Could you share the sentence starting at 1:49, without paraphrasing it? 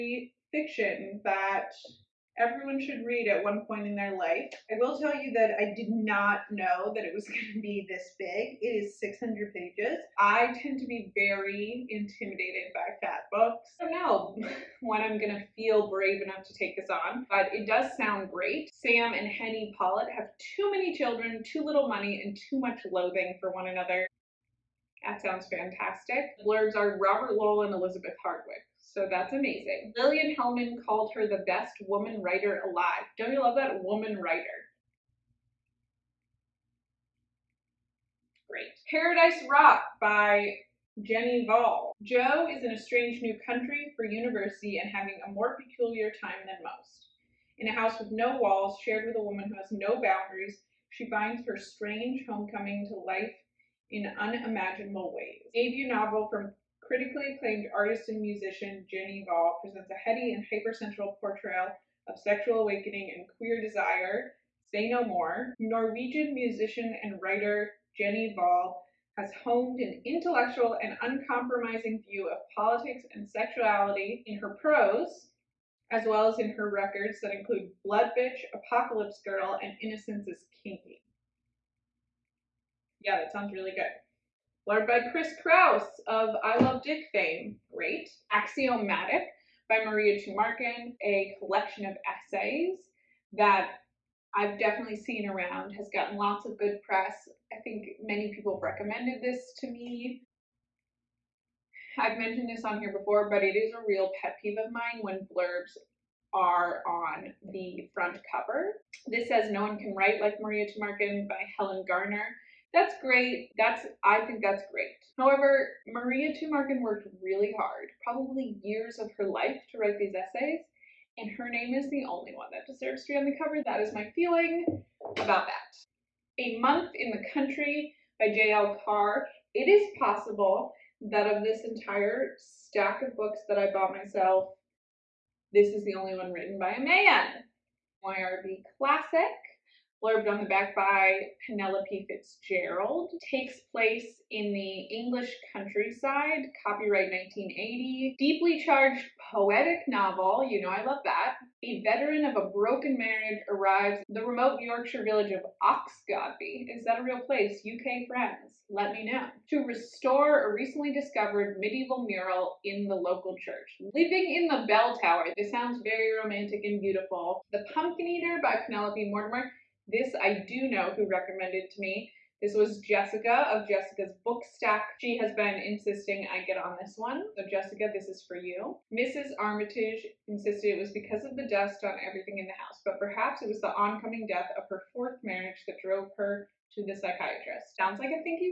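This says No One Can Write Like Maria Tumarkin by Helen Garner.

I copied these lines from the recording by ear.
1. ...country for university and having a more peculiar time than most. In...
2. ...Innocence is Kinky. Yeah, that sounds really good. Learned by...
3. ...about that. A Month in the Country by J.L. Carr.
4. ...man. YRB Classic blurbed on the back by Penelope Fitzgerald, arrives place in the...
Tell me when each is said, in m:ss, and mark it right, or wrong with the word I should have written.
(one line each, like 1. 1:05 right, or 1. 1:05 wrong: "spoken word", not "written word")
1. 0:43 right
2. 1:19 right
3. 2:05 right
4. 2:16 wrong: "takes", not "arrives".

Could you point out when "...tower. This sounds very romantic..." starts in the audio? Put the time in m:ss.
2:44.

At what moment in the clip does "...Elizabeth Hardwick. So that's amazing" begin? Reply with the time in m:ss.
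0:27.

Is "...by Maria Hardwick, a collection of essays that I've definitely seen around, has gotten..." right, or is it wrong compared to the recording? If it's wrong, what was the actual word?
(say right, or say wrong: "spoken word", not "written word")
wrong: "Tumarkin", not "Hardwick".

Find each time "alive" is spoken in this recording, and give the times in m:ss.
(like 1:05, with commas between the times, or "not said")
0:32.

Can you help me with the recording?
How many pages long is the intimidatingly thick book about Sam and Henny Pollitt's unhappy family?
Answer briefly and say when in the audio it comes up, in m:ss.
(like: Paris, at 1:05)
600, at 0:08.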